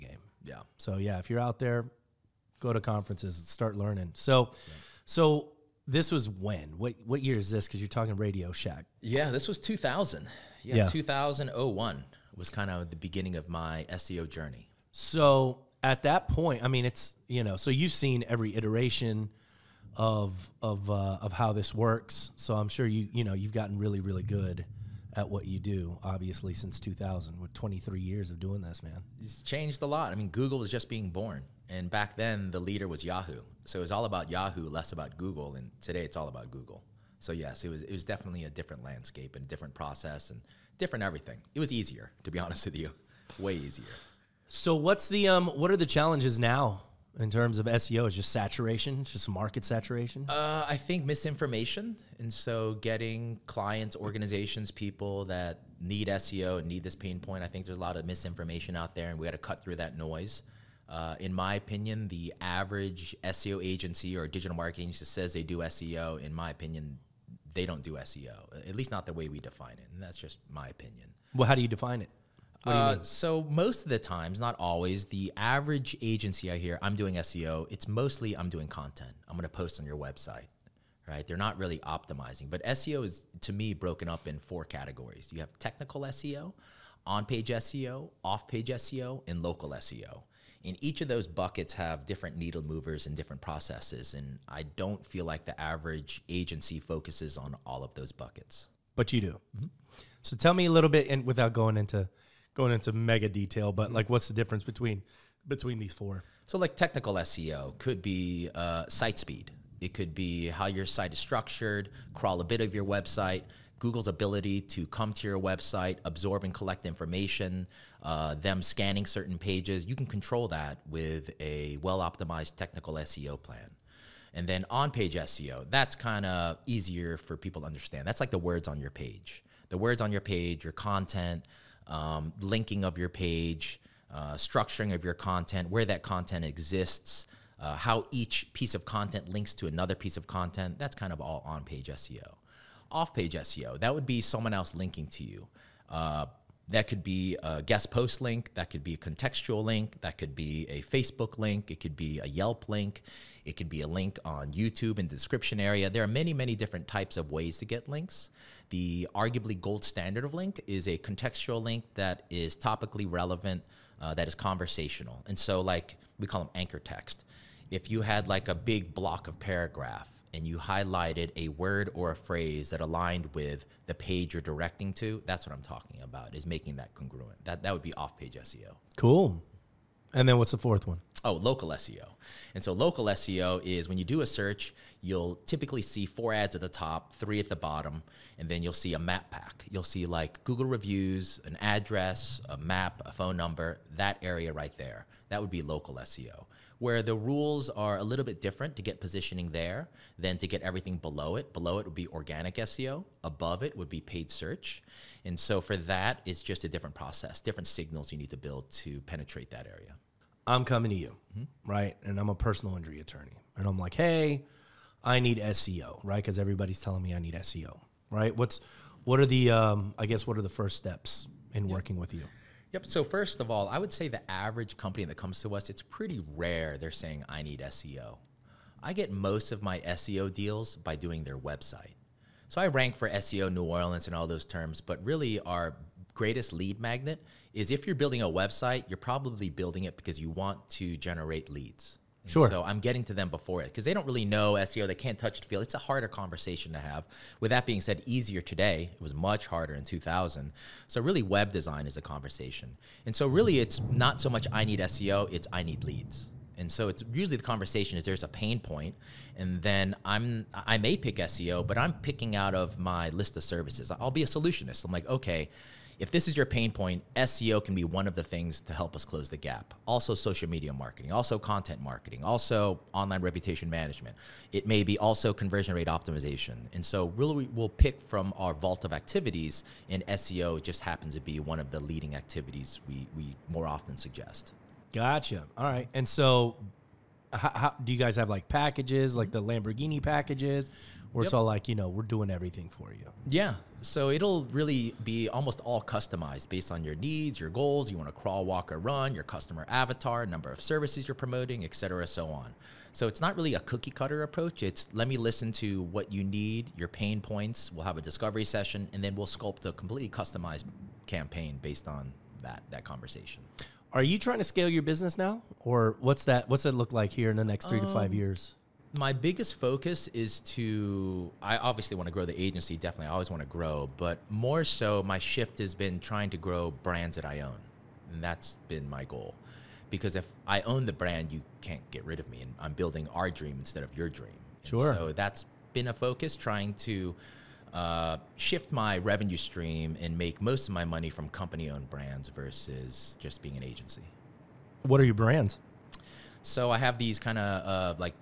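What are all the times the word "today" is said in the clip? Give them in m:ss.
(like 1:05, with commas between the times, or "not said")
0:35, 4:08.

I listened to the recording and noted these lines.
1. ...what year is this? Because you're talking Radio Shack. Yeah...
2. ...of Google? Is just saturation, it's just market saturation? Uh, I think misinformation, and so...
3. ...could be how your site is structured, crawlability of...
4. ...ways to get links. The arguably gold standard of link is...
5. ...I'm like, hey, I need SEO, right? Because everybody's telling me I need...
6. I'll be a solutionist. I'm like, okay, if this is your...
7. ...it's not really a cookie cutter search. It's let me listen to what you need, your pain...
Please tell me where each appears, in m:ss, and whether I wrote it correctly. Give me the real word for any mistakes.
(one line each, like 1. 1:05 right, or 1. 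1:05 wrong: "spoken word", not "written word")
1. 0:07 right
2. 0:47 wrong: "SEO", not "Google"
3. 1:49 right
4. 2:37 right
5. 3:33 right
6. 4:23 right
7. 5:03 wrong: "approach", not "search".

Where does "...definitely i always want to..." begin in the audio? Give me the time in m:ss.
5:22.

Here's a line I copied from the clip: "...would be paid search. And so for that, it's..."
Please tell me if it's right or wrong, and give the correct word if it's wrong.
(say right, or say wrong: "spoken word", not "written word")
right.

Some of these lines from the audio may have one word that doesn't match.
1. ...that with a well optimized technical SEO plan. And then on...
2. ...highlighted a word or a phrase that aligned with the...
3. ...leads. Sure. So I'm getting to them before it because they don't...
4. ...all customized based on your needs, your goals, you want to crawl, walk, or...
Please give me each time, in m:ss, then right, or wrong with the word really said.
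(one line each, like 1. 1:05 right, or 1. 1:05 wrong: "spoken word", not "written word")
1. 2:00 right
2. 2:50 right
3. 4:01 right
4. 4:55 right.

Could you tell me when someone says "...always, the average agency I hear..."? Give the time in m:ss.
1:14.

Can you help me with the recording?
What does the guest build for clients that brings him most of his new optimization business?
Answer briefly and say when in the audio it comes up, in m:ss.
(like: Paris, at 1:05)
Their website, at 3:50.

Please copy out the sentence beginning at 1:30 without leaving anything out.
And each of those buckets have different needle movers and different processes.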